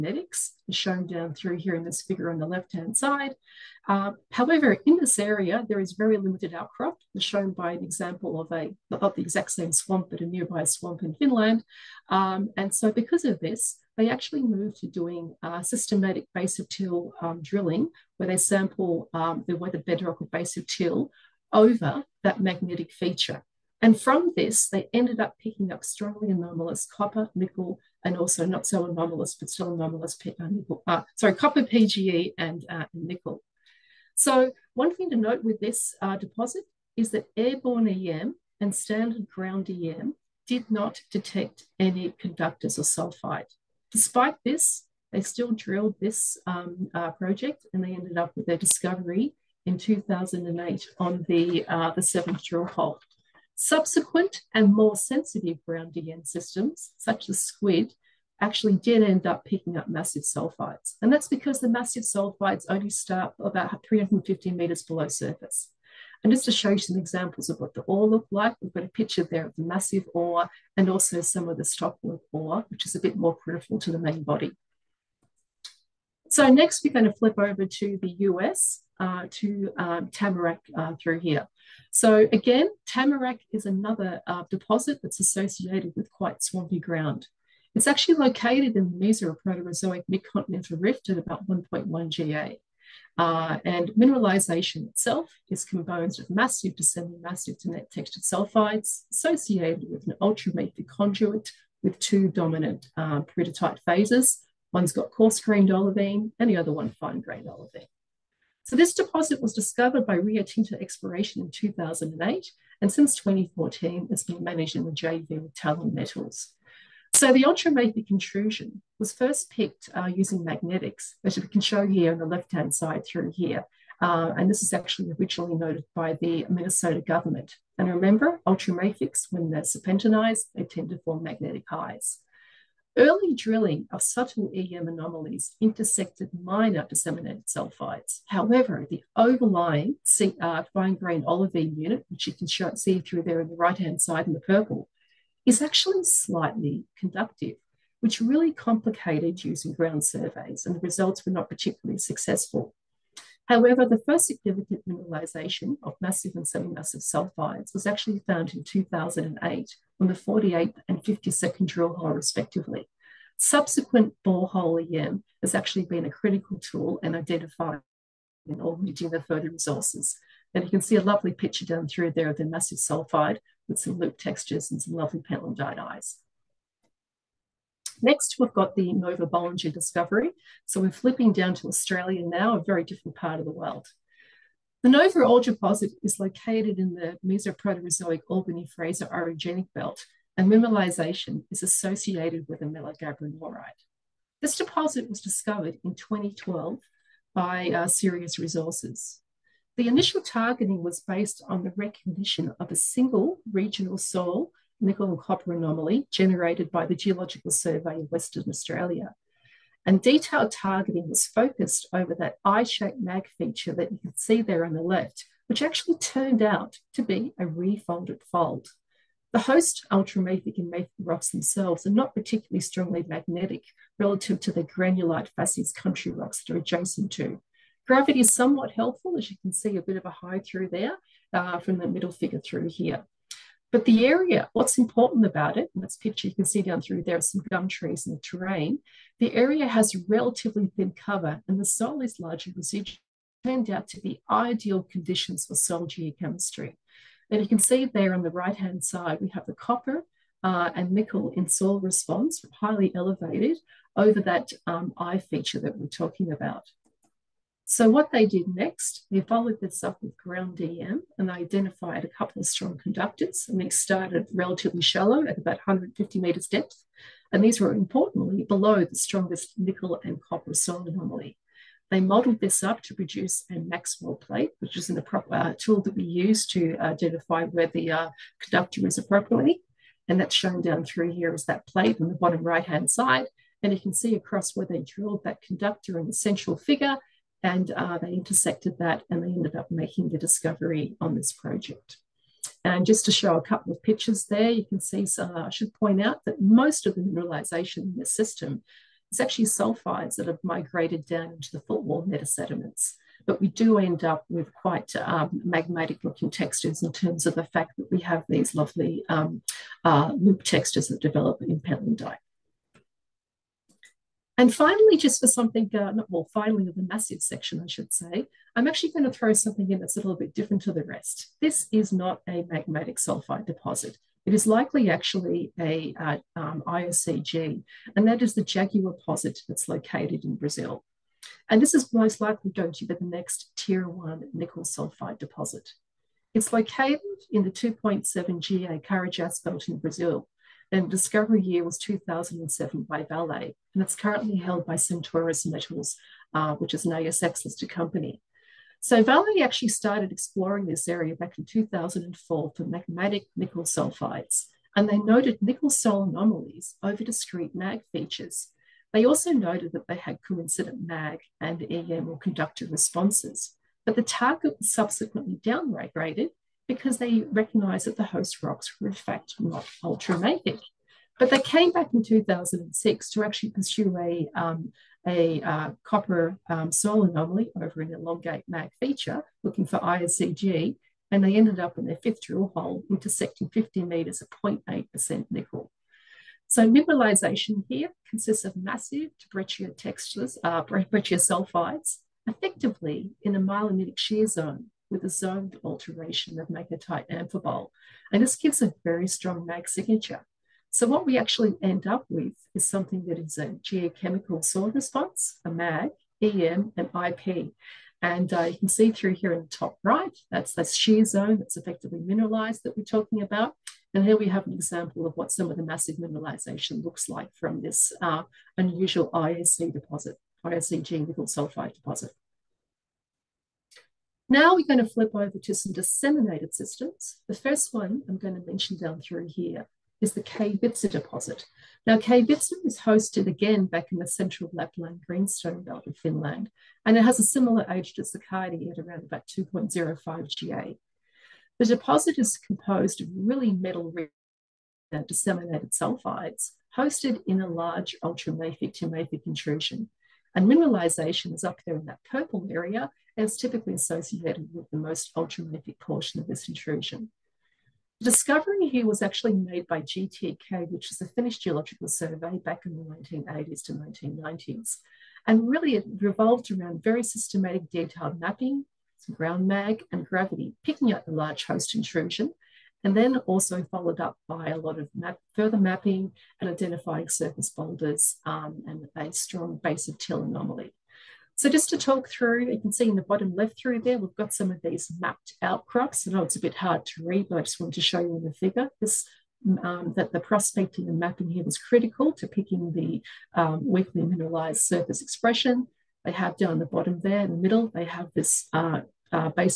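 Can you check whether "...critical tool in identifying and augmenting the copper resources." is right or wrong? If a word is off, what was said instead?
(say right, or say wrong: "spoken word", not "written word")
wrong: "further", not "copper".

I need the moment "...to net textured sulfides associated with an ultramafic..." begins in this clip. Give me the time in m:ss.
1:37.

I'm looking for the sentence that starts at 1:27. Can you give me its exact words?
It's actually located in the Mesoproterozoic midcontinental rift at about 1.1 GA.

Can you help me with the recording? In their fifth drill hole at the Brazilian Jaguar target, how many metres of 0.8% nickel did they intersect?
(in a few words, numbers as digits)
50 metres.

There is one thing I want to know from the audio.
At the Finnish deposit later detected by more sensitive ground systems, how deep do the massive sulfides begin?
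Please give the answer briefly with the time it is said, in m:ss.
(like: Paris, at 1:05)
About 350 meters, at 1:03.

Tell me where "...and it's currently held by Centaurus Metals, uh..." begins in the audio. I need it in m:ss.
5:43.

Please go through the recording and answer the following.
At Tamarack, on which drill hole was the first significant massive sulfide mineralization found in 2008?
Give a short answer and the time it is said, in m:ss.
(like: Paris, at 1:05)
48th, at 2:40.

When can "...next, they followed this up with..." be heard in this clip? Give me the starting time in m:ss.
4:18.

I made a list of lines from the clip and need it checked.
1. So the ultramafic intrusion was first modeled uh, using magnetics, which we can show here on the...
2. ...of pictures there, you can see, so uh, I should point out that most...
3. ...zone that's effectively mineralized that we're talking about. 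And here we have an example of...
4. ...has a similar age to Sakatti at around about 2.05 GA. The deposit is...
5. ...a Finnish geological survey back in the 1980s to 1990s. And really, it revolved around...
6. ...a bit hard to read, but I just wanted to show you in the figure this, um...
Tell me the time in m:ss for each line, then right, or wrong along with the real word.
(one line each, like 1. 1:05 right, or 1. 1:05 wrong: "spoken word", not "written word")
1. 1:57 wrong: "picked", not "modeled"
2. 4:53 right
3. 6:51 right
4. 7:17 right
5. 7:41 right
6. 8:06 right.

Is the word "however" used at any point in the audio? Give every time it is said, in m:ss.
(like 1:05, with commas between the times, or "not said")
0:04, 2:18, 2:33.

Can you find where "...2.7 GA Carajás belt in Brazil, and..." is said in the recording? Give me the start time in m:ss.
5:37.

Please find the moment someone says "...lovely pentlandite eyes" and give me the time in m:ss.
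2:54.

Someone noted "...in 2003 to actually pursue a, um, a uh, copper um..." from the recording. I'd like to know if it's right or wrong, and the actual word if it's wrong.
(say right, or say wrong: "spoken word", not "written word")
wrong: "2006", not "2003".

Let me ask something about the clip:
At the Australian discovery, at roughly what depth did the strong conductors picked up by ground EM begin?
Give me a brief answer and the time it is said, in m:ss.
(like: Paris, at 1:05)
About 150 meters, at 4:25.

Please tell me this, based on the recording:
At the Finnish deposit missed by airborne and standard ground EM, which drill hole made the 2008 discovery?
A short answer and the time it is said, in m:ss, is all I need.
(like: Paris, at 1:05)
Seventh, at 0:52.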